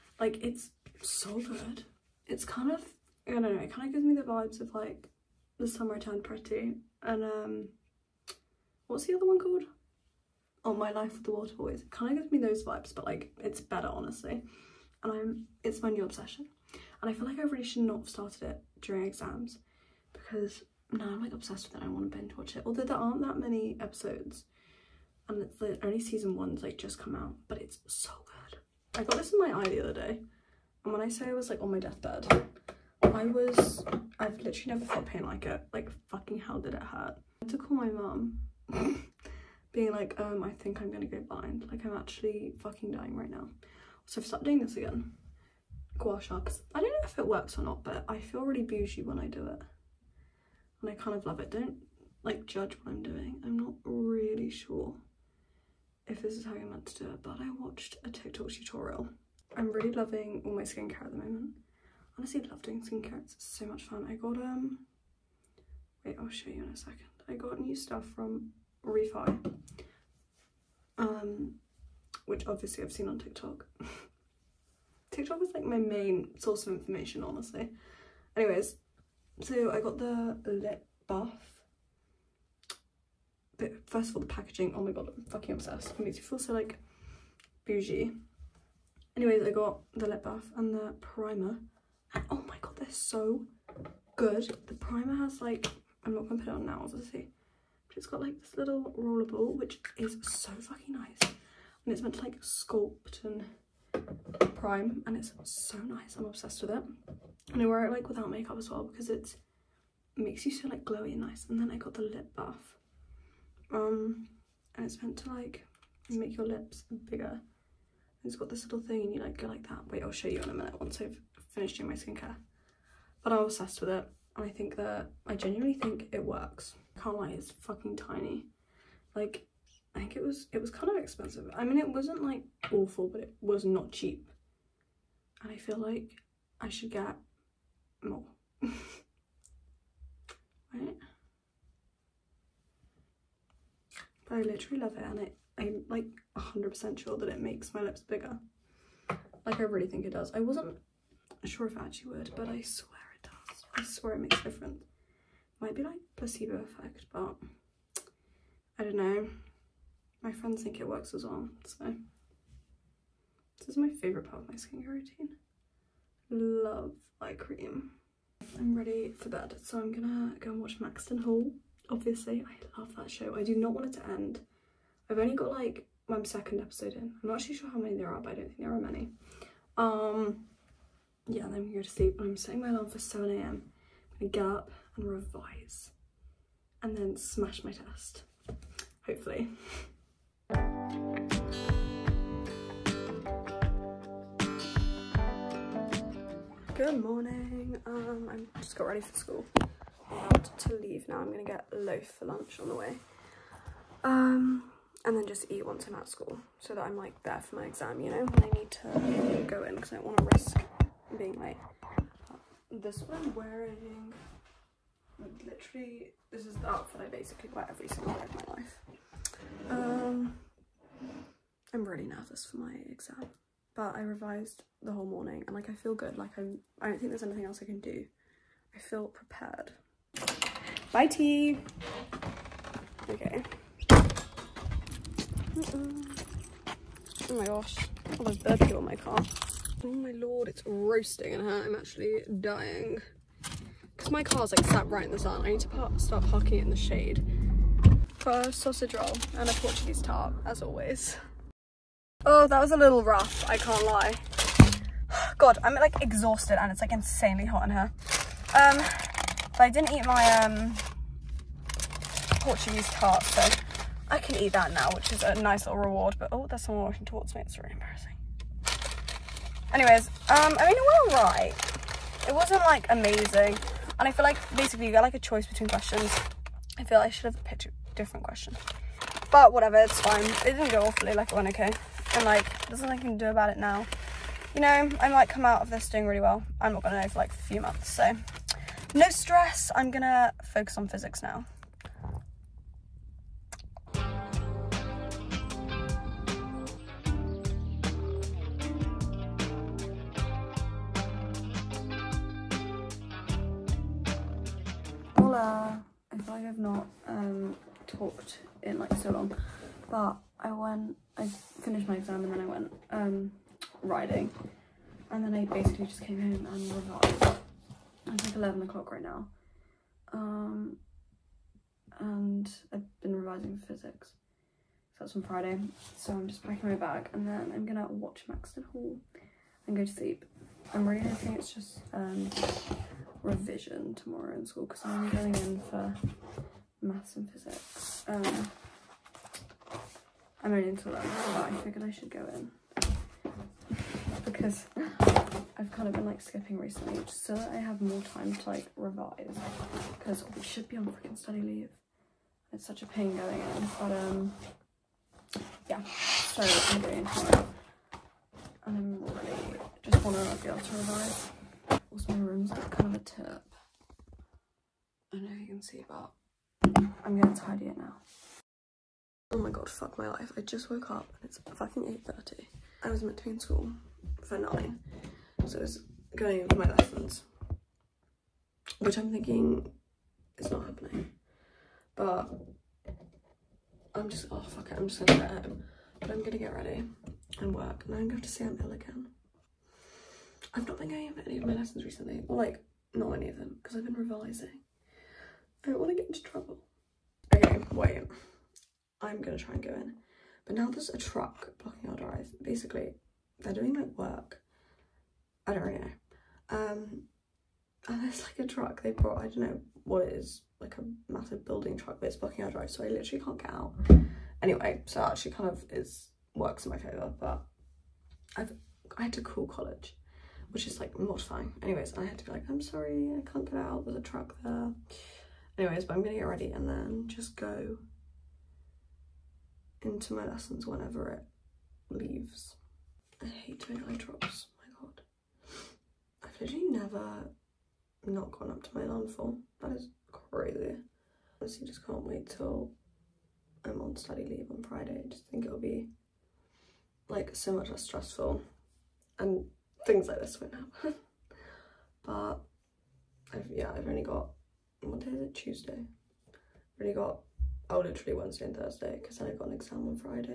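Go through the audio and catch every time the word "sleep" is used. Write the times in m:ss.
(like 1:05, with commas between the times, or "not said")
3:01, 5:29.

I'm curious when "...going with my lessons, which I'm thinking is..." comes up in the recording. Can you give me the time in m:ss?
6:16.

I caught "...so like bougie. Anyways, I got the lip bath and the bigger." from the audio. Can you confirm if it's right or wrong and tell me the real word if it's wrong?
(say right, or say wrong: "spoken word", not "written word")
wrong: "primer", not "bigger".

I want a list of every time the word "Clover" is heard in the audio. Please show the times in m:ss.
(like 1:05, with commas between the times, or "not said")
not said.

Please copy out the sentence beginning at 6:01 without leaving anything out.
Also, my room's like kind of a tip.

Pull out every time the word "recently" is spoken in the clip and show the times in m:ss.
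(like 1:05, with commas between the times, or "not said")
5:46, 6:31.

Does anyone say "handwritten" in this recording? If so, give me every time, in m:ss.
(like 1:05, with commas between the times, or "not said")
not said.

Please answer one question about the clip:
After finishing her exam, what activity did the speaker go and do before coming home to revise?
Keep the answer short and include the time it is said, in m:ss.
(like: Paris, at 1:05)
Riding, at 5:13.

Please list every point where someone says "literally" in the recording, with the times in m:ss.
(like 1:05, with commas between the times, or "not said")
0:34, 2:24, 3:35, 6:52, 7:16, 7:37.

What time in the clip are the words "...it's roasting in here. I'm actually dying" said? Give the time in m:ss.
4:00.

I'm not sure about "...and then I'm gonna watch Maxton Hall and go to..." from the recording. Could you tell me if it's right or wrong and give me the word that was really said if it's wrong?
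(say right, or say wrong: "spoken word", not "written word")
right.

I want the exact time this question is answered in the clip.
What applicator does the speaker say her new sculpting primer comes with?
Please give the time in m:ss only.
1:38.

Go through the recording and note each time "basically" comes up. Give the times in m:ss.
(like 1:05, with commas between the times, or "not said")
3:37, 4:34, 5:15, 6:42.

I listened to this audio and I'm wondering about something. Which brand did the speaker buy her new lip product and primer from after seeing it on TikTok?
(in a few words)
Refy.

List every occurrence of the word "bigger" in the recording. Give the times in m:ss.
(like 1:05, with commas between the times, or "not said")
1:57, 2:28.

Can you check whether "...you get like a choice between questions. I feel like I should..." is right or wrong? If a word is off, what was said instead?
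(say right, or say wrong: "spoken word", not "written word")
right.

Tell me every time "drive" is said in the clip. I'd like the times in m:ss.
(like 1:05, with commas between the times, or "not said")
6:41, 6:52.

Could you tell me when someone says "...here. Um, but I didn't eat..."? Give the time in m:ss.
4:17.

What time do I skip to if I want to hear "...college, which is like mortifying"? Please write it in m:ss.
6:59.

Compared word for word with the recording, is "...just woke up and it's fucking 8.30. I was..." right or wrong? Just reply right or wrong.
right.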